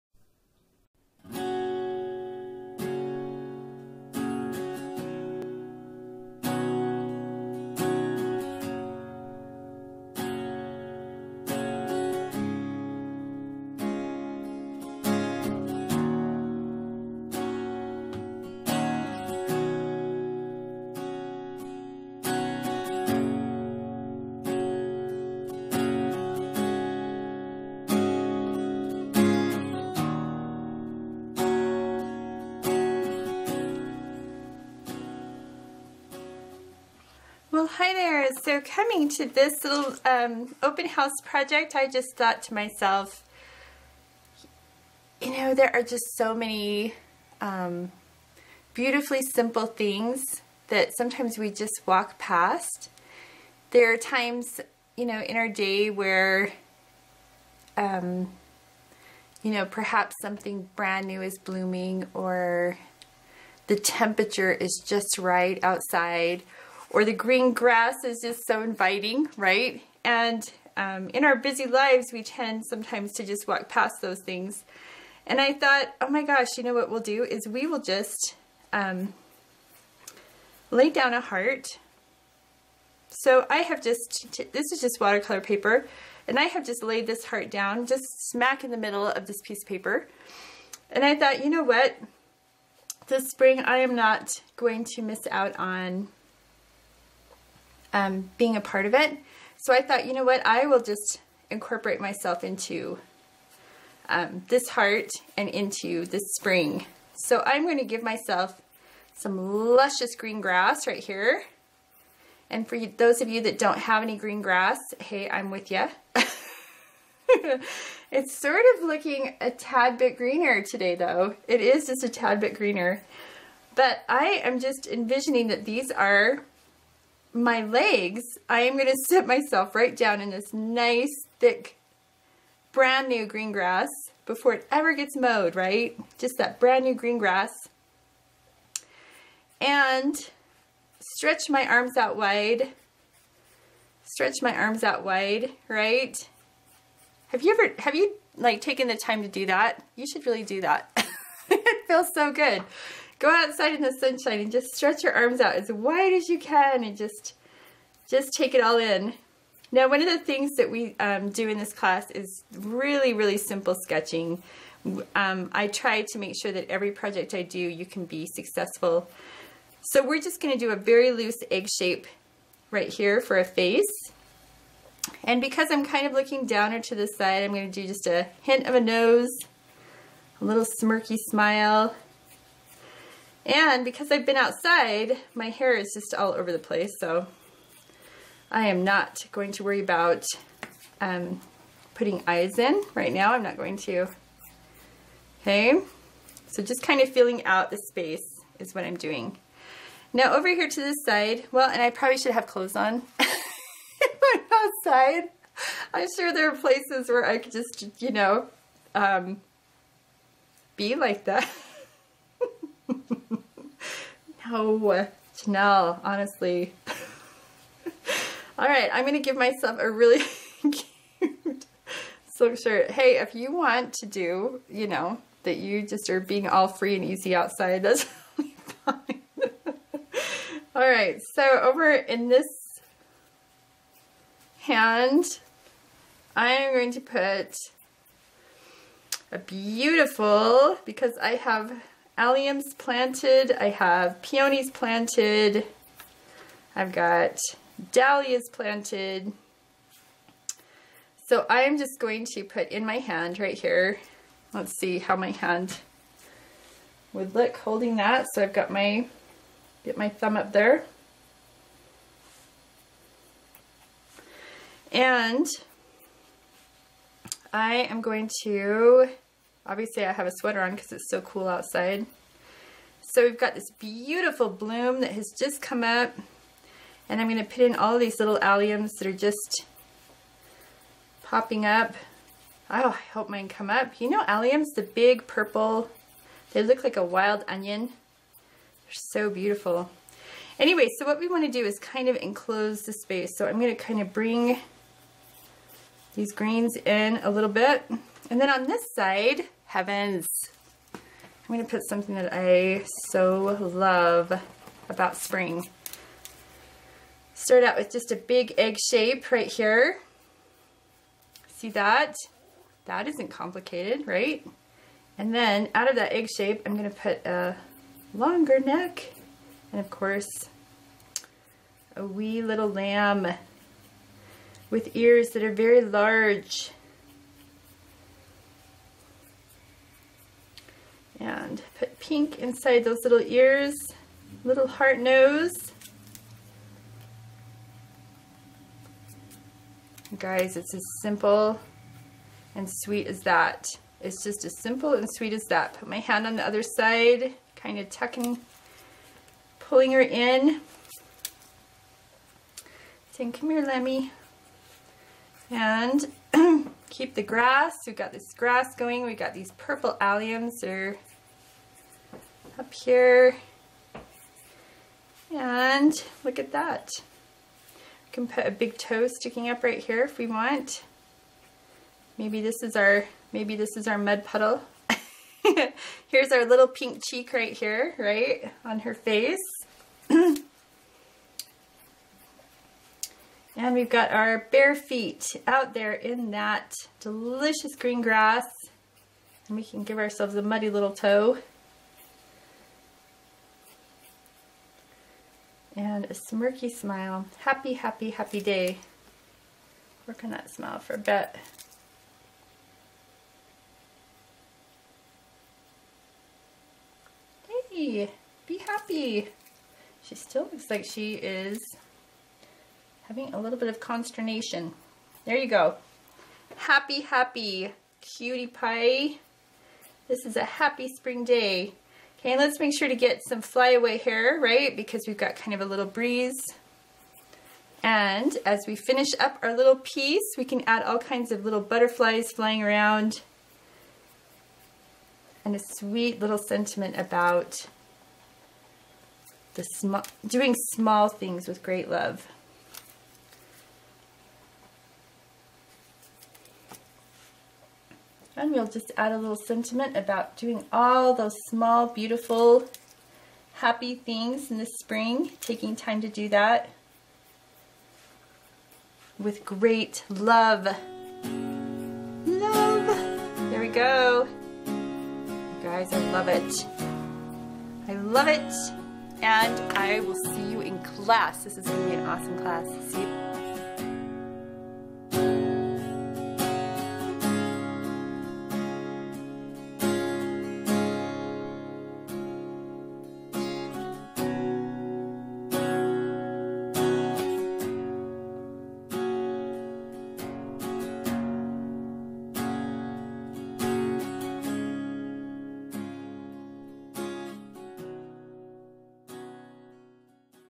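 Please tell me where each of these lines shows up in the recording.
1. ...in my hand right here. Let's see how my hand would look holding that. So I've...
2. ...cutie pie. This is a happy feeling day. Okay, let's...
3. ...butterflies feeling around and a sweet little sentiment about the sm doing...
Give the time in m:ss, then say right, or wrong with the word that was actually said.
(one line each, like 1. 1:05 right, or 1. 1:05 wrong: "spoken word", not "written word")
1. 4:12 right
2. 6:58 wrong: "spring", not "feeling"
3. 7:11 wrong: "flying", not "feeling".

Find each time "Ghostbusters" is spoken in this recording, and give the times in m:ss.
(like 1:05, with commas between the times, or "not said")
not said.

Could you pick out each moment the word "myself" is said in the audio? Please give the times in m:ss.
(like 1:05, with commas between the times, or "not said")
0:42, 1:41, 1:48, 2:09, 3:39.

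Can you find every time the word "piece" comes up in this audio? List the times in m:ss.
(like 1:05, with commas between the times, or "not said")
1:29, 7:09.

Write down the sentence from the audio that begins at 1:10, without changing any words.
And um, in our busy lives, we tend sometimes to just walk past those things.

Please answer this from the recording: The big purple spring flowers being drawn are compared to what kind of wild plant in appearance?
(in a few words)
Wild onion.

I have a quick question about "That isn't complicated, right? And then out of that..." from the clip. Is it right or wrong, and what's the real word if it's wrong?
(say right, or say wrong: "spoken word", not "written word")
right.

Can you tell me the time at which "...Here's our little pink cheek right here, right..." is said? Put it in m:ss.
6:16.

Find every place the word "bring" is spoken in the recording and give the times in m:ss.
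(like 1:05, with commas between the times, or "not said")
4:54.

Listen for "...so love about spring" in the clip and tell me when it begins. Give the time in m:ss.
5:03.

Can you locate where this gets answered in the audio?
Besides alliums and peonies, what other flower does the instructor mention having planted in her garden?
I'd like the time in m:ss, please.
4:07.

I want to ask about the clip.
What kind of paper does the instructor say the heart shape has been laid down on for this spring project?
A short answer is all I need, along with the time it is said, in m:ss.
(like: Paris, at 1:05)
Watercolor paper, at 1:24.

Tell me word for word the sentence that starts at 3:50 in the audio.
all right, so over in this hand, I am going to put a beautiful, because I have alliums planted.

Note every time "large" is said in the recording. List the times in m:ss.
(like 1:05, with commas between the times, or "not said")
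5:25.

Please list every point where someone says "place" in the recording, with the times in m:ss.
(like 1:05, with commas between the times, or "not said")
3:06, 3:26.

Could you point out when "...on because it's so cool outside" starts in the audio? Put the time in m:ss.
4:30.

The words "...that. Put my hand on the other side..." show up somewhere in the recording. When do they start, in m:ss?
5:45.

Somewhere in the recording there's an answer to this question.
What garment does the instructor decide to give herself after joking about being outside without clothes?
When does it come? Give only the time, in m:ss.
3:42.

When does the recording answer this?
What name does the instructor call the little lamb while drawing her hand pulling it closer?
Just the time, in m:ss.
5:53.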